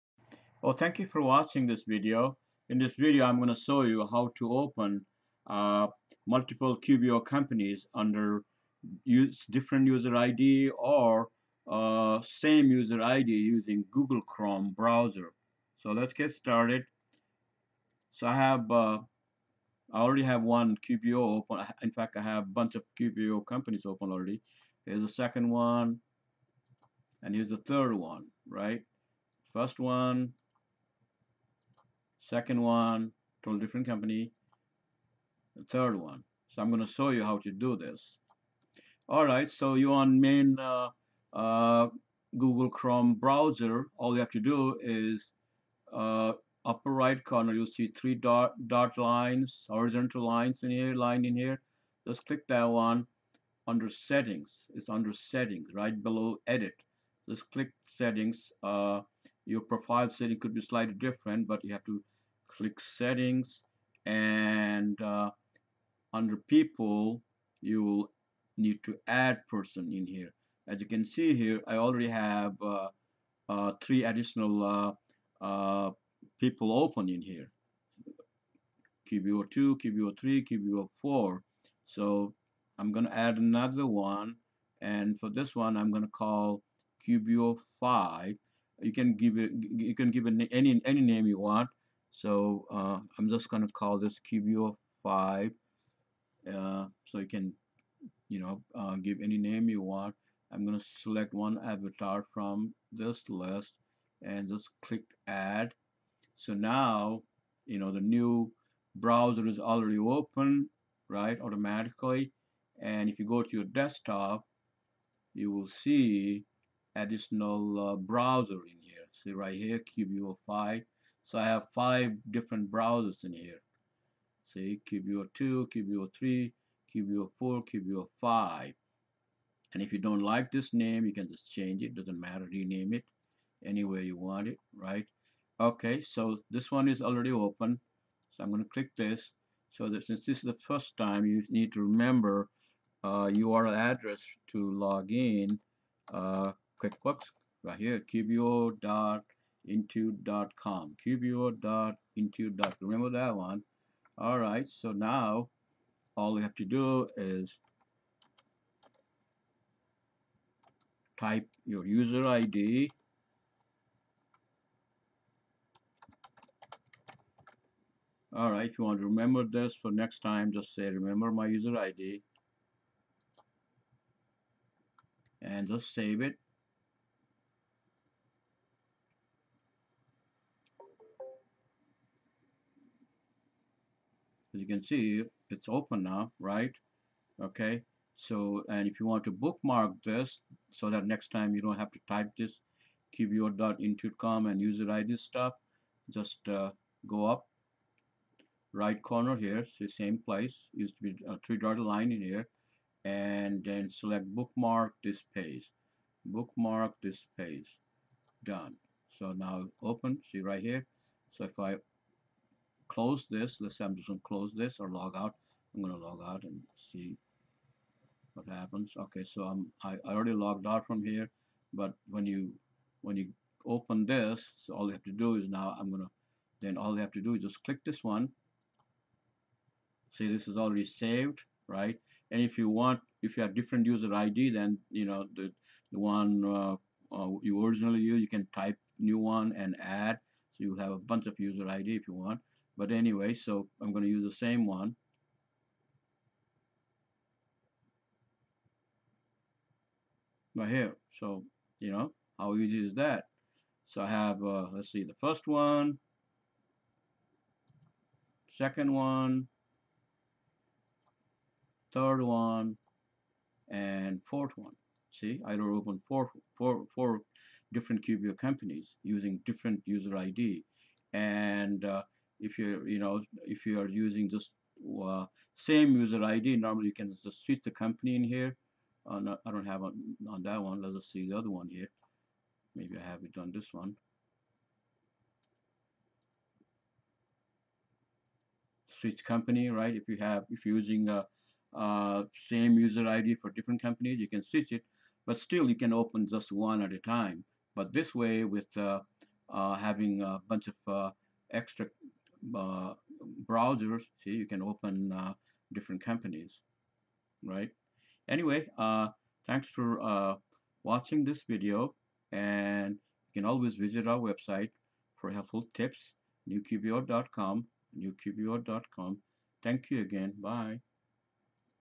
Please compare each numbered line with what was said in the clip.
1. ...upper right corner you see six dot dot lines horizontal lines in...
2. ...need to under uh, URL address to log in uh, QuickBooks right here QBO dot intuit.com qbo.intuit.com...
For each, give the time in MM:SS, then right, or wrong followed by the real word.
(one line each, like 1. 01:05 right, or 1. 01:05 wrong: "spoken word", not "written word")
1. 00:46 wrong: "three", not "six"
2. 02:21 wrong: "remember", not "under".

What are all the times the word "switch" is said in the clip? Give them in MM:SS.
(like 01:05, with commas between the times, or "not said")
04:37, 04:48, 04:54.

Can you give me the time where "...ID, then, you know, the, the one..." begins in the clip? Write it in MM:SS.
03:54.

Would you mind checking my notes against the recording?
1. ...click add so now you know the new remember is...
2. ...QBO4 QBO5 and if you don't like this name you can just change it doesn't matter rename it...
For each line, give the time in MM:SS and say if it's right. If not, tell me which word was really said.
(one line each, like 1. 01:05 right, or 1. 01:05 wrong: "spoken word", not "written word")
1. 01:44 wrong: "browser", not "remember"
2. 02:06 right.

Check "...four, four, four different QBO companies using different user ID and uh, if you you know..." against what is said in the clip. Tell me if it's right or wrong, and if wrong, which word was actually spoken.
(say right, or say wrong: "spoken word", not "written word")
right.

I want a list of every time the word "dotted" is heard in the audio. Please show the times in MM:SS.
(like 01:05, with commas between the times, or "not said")
03:21.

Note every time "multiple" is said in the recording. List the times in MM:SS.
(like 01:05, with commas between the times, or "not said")
00:06.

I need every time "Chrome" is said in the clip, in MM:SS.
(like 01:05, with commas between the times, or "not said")
00:14, 00:42.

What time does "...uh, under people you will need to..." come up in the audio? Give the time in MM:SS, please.
01:05.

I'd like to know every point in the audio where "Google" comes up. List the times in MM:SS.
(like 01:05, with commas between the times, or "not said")
00:13, 00:42.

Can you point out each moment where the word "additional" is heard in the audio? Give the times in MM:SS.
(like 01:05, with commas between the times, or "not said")
01:14, 01:56.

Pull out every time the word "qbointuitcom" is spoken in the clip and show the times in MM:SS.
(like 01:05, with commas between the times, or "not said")
02:31, 03:13.